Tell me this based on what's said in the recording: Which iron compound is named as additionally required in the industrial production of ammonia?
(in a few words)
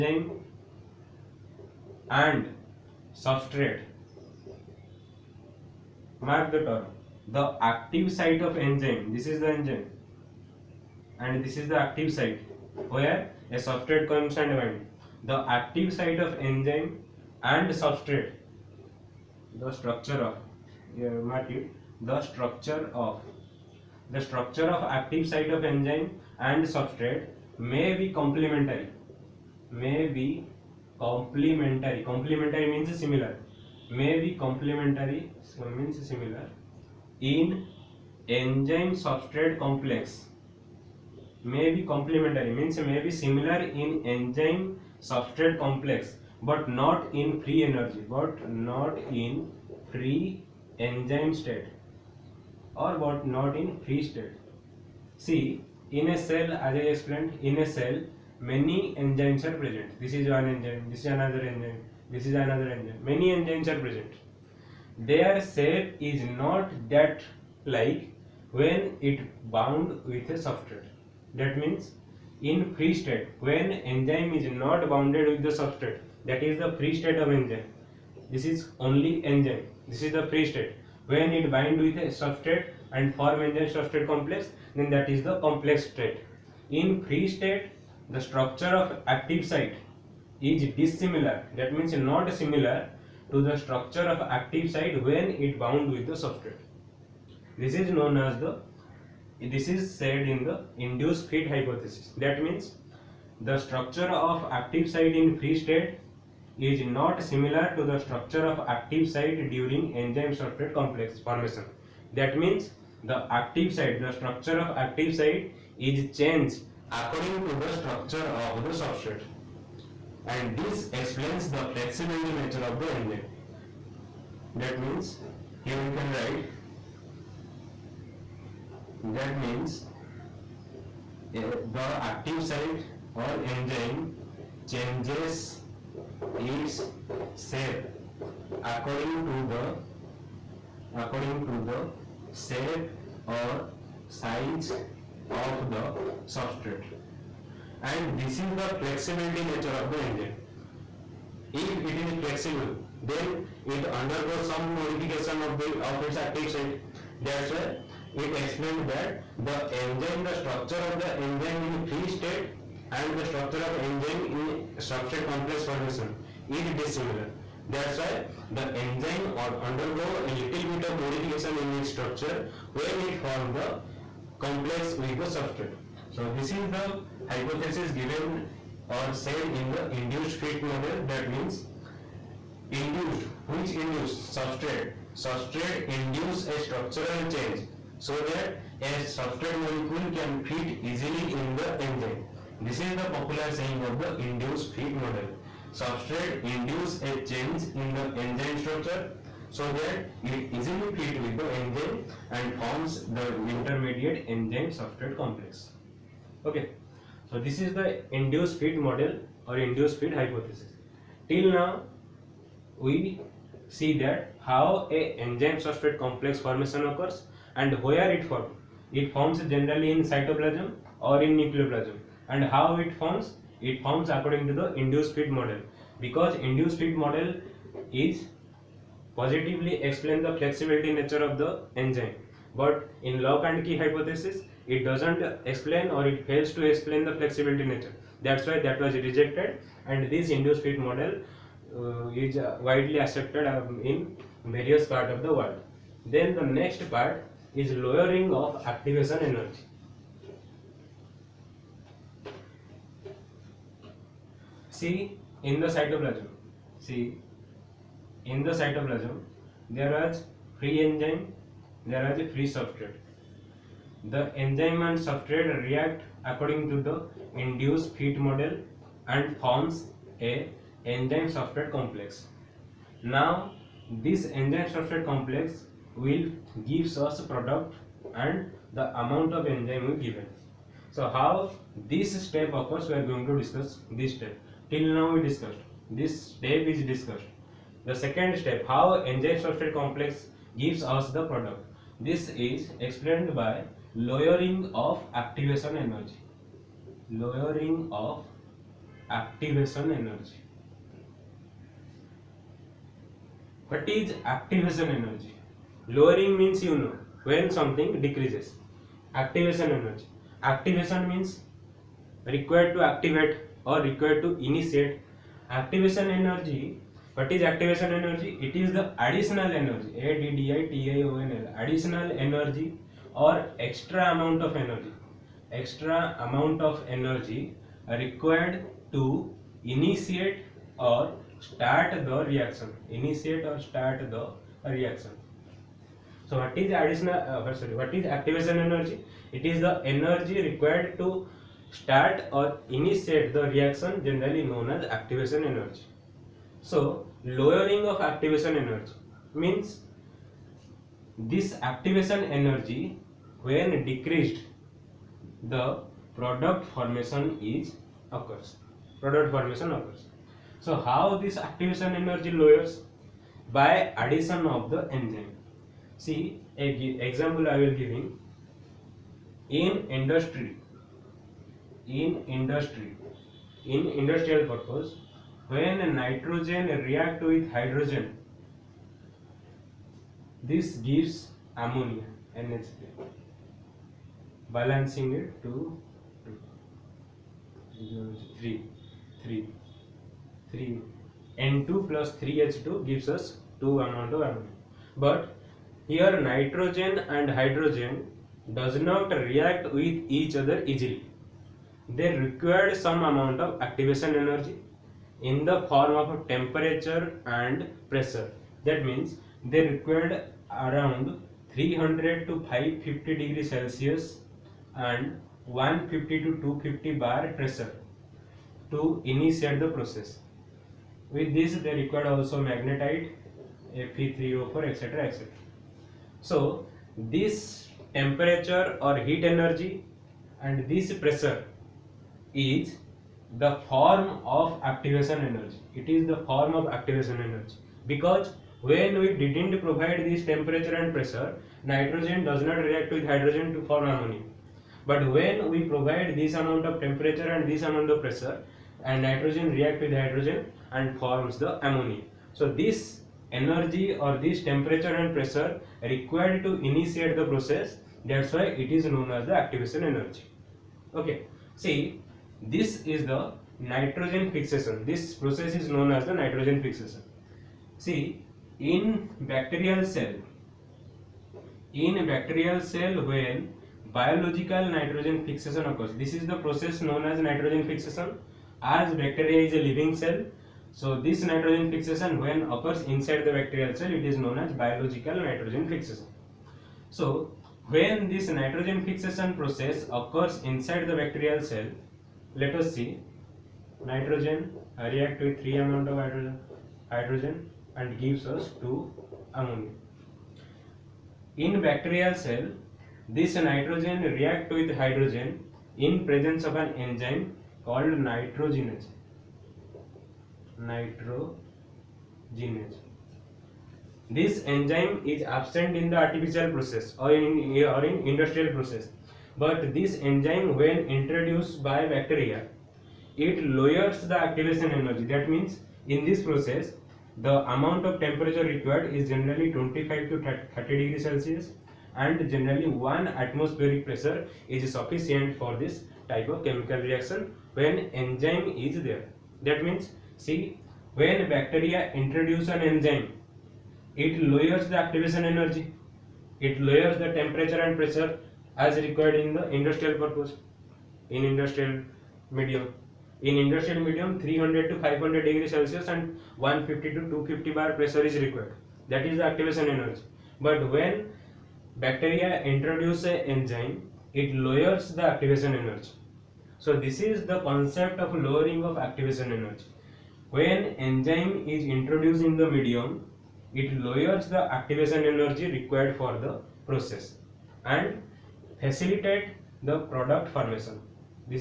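magnetite.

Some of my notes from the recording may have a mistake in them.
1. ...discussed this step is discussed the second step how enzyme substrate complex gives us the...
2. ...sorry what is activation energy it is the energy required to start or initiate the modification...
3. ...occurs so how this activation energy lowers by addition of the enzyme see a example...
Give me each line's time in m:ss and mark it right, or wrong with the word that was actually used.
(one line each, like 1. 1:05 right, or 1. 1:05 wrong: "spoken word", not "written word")
1. 4:45 right
2. 5:37 wrong: "reaction", not "modification"
3. 5:59 right.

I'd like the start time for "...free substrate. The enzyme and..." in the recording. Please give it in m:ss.
4:22.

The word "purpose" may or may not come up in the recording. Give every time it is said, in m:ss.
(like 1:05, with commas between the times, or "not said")
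6:14, 9:09.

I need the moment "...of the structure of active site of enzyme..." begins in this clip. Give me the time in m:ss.
0:23.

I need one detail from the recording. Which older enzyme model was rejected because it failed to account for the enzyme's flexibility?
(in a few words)
Lock and Key hypothesis.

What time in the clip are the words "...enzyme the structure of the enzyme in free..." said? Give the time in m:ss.
2:39.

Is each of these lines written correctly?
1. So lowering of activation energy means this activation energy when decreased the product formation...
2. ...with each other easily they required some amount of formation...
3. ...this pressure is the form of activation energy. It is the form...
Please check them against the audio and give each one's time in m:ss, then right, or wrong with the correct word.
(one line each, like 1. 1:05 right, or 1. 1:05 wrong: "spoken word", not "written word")
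1. 5:46 right
2. 6:39 wrong: "activation", not "formation"
3. 7:10 right.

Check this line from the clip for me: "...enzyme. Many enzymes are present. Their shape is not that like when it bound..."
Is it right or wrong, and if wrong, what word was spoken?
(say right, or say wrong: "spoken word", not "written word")
right.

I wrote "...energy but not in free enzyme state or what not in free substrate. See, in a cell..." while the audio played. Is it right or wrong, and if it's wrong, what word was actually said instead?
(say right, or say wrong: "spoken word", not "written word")
wrong: "state", not "substrate".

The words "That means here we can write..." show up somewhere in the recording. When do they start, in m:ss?
2:04.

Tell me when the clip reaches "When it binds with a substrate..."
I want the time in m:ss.
1:21.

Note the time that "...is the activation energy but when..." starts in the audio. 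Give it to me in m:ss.
9:19.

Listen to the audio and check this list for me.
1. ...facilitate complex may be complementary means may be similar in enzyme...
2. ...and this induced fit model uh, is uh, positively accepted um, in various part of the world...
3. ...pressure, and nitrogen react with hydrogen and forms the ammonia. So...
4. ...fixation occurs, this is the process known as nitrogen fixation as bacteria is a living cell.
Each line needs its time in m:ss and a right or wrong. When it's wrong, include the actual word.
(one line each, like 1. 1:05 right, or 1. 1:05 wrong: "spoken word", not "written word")
1. 0:39 wrong: "substrate", not "facilitate"
2. 3:59 wrong: "widely", not "positively"
3. 7:28 right
4. 7:55 right.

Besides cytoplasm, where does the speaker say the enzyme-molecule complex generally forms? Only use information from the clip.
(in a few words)
nucleoplasm.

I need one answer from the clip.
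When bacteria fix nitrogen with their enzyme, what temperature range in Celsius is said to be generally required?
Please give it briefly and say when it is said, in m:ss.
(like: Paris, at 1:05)
25 to 30 degrees, at 8:49.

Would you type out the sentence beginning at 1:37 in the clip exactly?
This is known as the this is said in the induced fit hypothesis.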